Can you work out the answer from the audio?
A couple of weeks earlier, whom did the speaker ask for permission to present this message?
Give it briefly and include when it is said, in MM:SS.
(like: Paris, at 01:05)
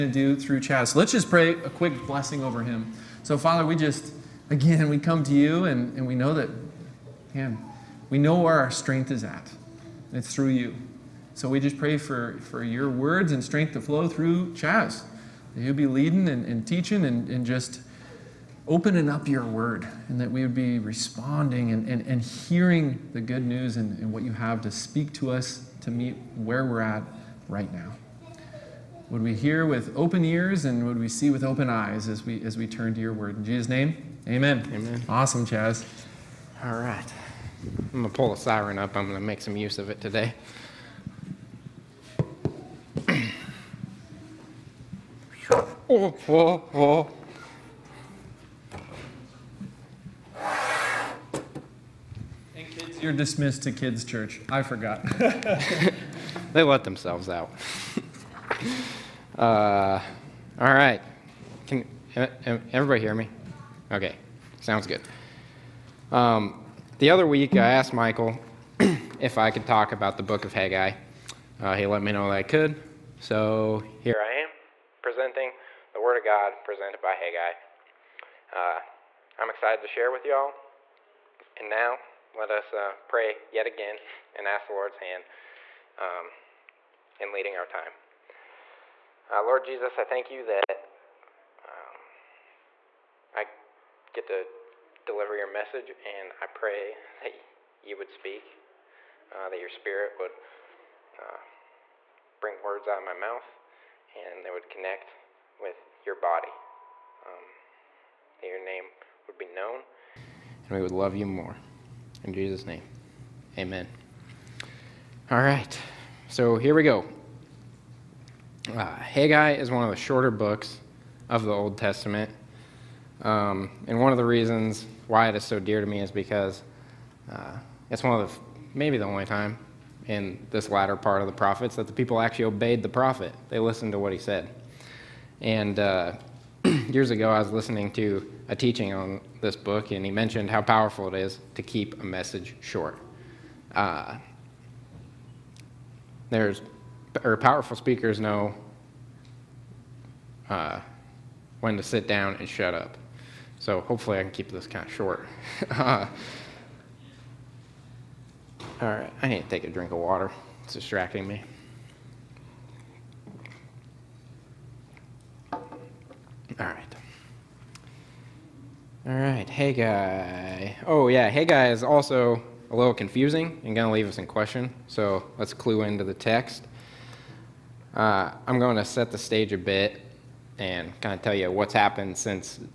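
Michael, at 01:07.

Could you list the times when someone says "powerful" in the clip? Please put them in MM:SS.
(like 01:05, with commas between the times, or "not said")
02:20, 02:27.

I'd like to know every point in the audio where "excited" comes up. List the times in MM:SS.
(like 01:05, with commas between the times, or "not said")
01:19.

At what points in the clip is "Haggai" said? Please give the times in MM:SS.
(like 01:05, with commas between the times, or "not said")
01:10, 01:17, 01:58.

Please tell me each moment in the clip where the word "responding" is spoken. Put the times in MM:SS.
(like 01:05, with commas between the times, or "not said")
00:20.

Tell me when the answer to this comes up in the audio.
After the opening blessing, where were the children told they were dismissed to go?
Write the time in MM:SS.
00:53.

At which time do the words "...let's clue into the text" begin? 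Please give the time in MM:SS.
02:55.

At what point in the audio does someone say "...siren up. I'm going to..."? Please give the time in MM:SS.
00:38.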